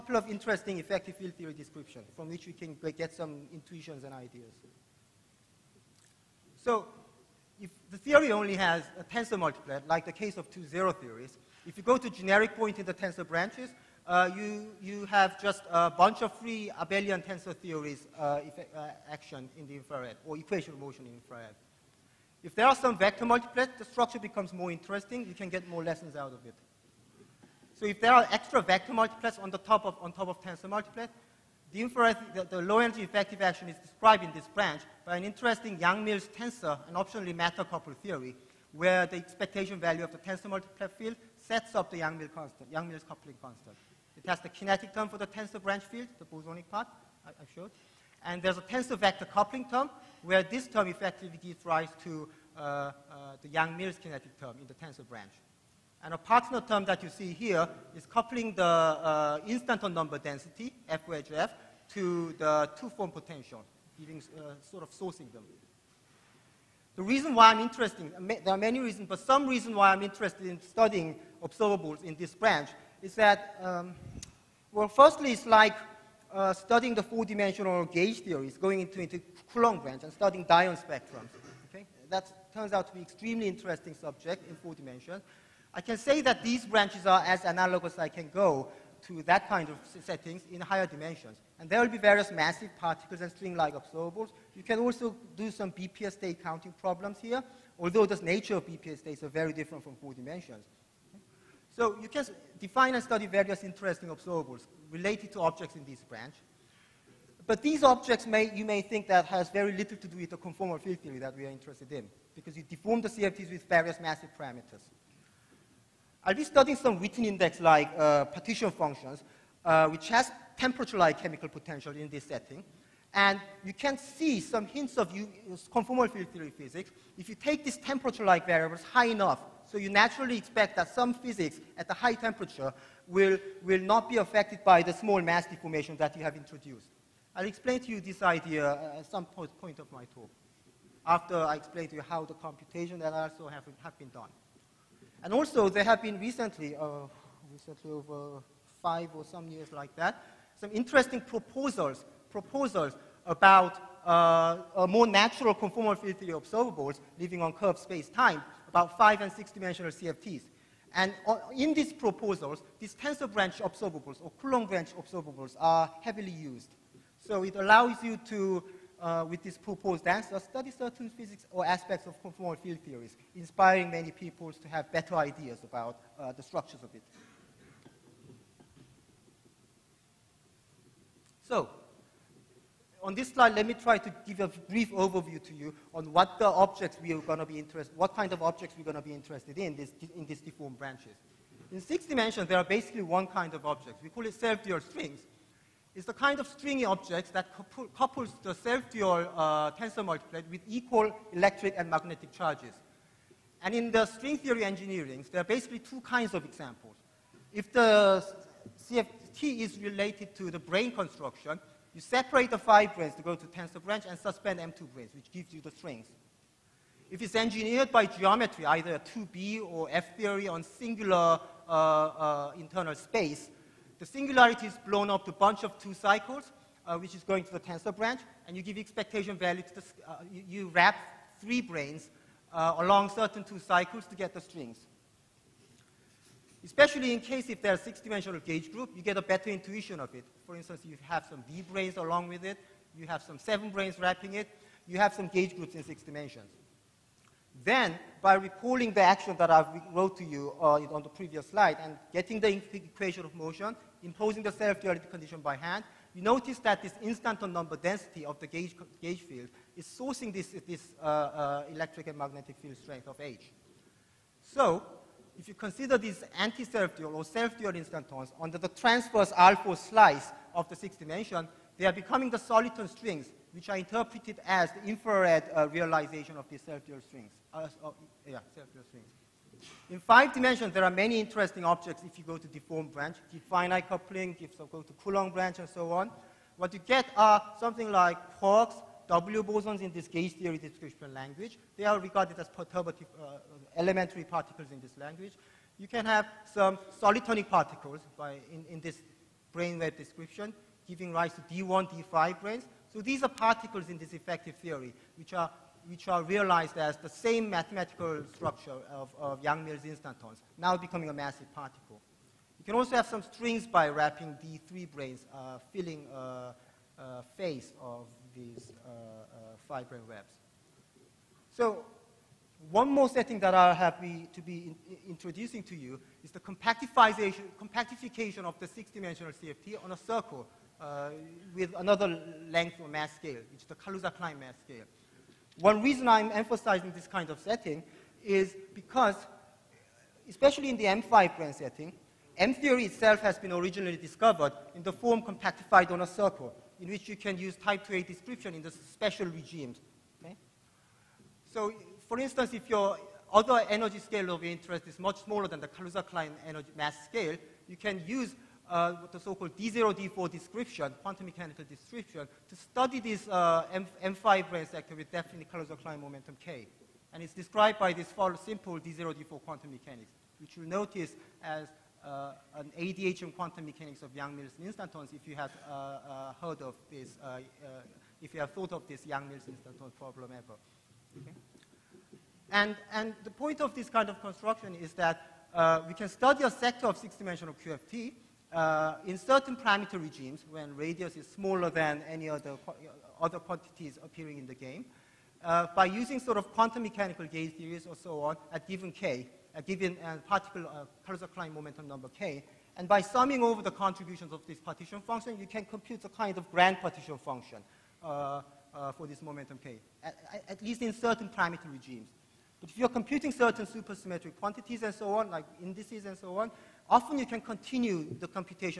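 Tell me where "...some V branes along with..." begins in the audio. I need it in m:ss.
4:01.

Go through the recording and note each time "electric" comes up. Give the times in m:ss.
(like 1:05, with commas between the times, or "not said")
3:21, 4:21.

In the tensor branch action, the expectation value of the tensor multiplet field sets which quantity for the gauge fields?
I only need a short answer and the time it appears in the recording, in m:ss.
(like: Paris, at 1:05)
Yang-Mills coupling constant, at 0:42.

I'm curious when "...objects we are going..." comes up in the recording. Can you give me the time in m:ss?
3:06.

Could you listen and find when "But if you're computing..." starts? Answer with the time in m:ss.
6:52.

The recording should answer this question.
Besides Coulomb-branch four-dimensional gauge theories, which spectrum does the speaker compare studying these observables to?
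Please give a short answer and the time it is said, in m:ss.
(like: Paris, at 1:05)
Dyon spectrums, at 1:20.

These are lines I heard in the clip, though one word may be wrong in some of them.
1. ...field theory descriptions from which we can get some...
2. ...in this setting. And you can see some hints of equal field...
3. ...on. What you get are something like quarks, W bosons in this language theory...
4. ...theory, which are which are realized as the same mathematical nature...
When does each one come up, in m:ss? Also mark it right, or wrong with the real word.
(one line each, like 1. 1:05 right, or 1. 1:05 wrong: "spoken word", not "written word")
1. 0:01 right
2. 2:01 wrong: "conformal", not "equal"
3. 4:45 wrong: "gauge", not "language"
4. 5:04 wrong: "structure", not "nature".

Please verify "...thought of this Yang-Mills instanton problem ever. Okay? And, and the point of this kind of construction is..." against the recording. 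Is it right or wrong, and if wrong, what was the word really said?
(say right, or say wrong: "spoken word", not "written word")
right.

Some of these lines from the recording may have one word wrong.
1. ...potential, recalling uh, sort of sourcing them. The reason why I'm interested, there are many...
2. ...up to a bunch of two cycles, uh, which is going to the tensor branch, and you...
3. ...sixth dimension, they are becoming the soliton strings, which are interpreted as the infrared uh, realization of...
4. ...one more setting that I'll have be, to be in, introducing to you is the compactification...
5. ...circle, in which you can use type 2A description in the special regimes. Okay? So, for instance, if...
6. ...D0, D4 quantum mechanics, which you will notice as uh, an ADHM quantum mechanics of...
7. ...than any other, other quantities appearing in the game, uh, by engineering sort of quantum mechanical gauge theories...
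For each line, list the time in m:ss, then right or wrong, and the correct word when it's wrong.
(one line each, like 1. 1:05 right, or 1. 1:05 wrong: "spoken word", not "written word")
1. 1:03 wrong: "giving", not "recalling"
2. 3:45 right
3. 4:30 right
4. 5:22 right
5. 5:46 right
6. 6:08 right
7. 6:31 wrong: "using", not "engineering".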